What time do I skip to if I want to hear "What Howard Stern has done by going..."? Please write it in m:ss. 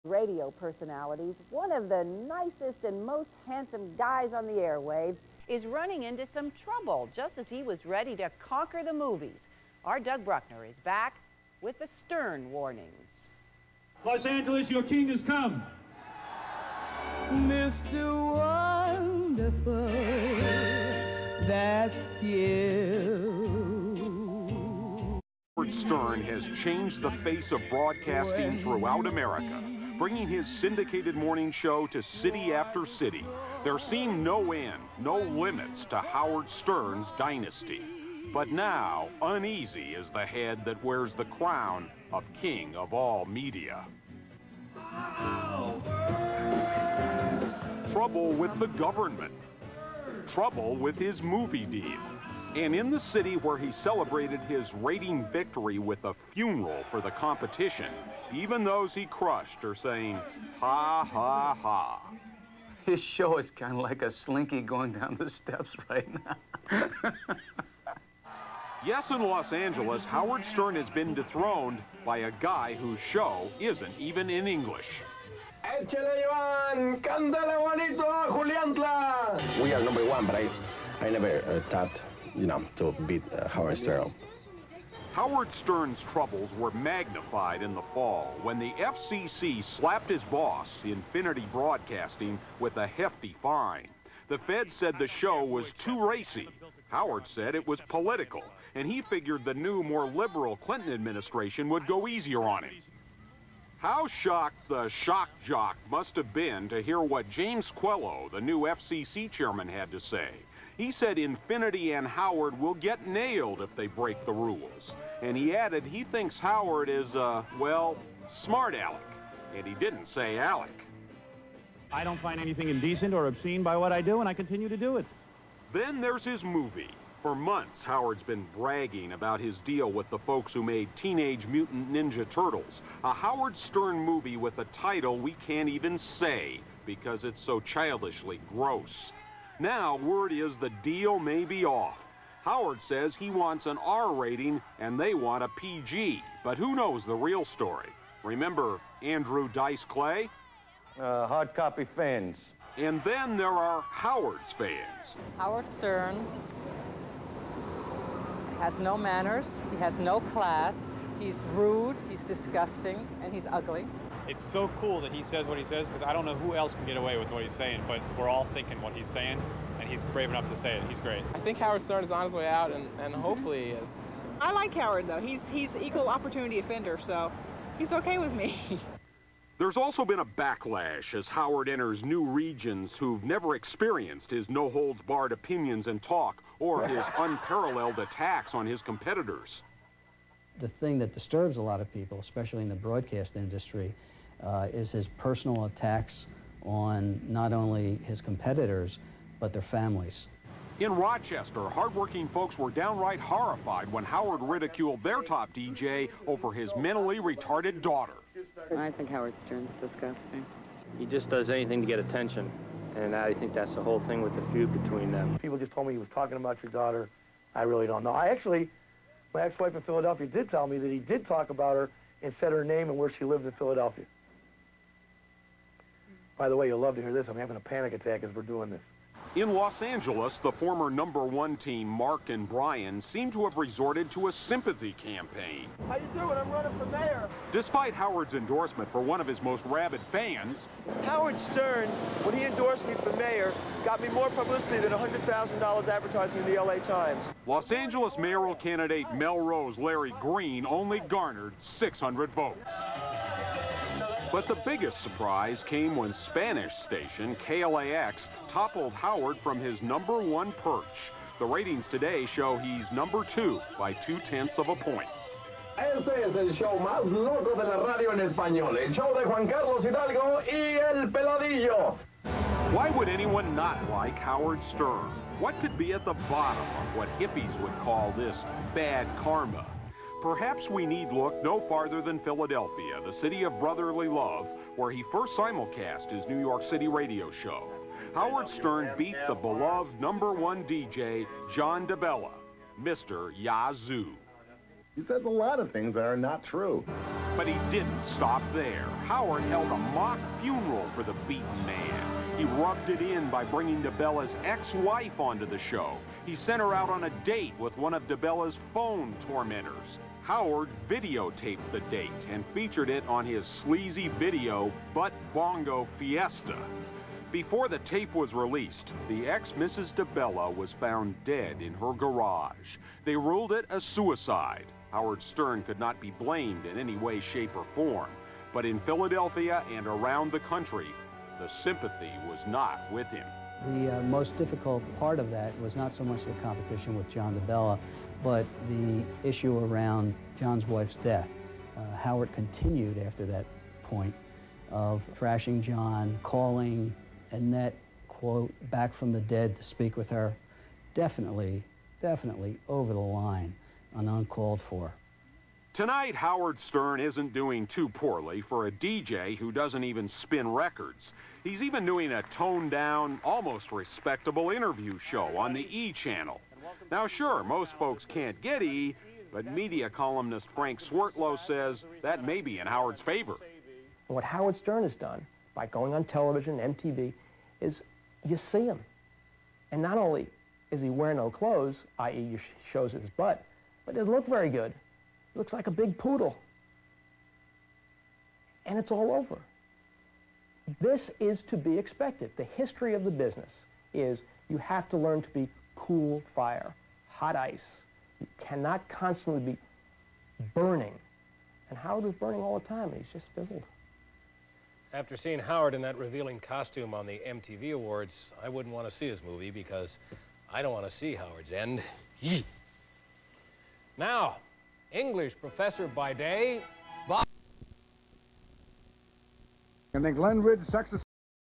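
6:14.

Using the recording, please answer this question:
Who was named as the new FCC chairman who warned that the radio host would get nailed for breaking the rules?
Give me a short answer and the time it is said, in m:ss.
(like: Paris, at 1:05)
James Quello, at 1:47.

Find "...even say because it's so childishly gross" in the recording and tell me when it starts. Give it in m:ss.
2:15.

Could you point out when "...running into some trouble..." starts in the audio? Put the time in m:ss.
0:05.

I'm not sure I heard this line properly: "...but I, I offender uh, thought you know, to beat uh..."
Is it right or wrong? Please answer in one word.
wrong.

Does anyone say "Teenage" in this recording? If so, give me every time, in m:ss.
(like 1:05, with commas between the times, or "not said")
2:10.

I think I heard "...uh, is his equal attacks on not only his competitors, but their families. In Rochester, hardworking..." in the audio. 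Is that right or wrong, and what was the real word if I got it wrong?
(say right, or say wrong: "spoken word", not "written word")
wrong: "personal", not "equal".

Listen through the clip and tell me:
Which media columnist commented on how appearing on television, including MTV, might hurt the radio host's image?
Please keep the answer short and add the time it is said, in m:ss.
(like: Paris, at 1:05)
Frank Swertlow, at 6:10.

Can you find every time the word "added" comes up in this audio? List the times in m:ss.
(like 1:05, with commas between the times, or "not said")
1:55.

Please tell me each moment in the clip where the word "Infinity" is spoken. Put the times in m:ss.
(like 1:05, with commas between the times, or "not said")
1:30, 1:51.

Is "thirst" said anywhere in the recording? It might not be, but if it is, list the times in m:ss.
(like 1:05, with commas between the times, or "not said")
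not said.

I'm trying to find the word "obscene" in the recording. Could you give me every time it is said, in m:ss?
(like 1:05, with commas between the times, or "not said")
2:03.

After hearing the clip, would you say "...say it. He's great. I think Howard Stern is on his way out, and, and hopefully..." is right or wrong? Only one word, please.
right.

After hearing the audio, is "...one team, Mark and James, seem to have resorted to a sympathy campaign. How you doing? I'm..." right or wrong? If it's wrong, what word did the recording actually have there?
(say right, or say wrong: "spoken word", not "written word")
wrong: "Brian", not "James".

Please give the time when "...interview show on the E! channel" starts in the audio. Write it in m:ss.
6:04.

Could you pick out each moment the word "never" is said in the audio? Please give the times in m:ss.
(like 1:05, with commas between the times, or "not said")
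1:21, 3:03.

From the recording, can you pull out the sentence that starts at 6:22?
shows his butt, but it doesn't look very good.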